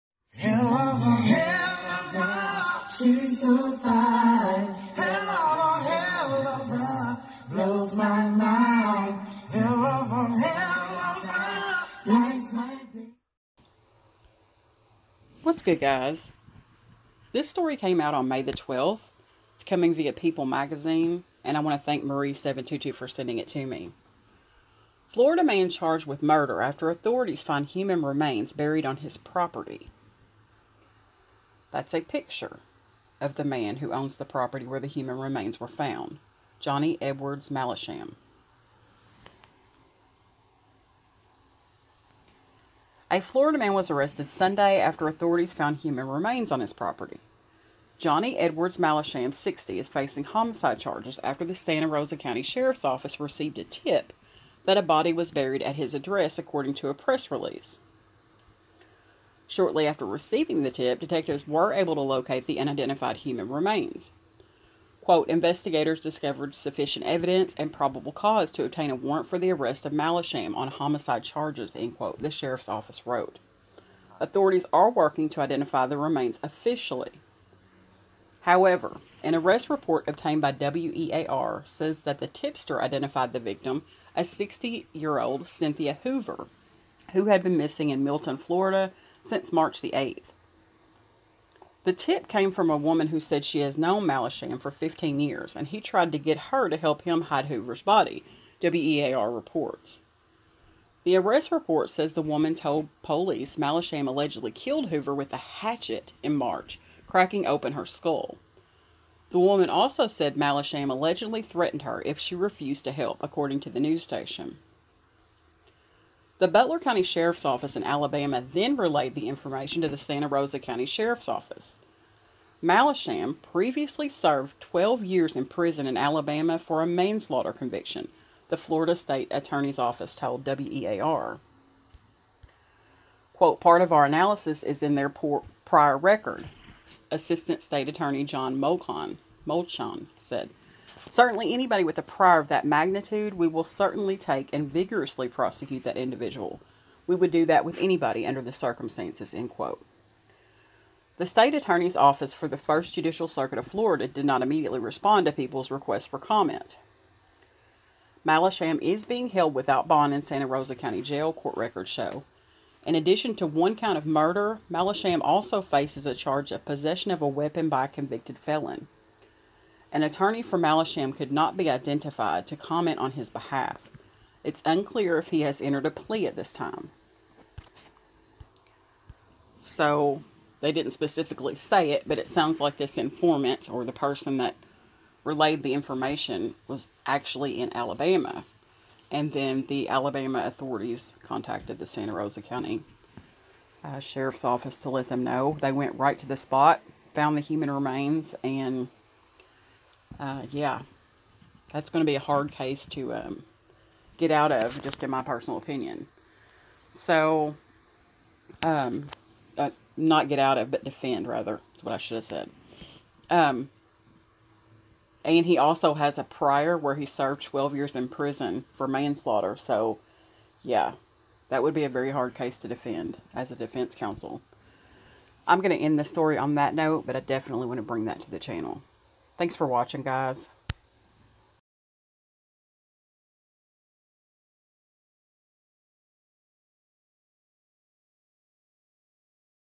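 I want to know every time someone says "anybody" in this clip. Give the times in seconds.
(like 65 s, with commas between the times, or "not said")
141 s, 147 s.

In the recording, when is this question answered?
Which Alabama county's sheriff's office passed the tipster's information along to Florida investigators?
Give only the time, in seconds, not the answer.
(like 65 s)
116 s.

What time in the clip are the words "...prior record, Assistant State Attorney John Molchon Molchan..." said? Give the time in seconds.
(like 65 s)
135 s.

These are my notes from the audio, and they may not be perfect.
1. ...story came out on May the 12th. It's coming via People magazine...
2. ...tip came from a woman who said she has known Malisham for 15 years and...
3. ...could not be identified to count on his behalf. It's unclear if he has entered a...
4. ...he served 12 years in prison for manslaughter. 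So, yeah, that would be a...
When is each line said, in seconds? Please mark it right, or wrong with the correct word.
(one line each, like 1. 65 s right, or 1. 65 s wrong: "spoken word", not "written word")
1. 17 s right
2. 91 s right
3. 171 s wrong: "comment", not "count"
4. 216 s right.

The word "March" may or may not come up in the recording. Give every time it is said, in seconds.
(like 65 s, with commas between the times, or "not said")
89 s, 106 s.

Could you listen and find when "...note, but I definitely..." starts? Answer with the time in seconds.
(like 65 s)
226 s.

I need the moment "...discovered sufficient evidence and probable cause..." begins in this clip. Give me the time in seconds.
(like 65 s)
65 s.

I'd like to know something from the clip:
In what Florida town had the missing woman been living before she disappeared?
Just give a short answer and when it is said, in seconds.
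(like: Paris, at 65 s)
Milton, at 88 s.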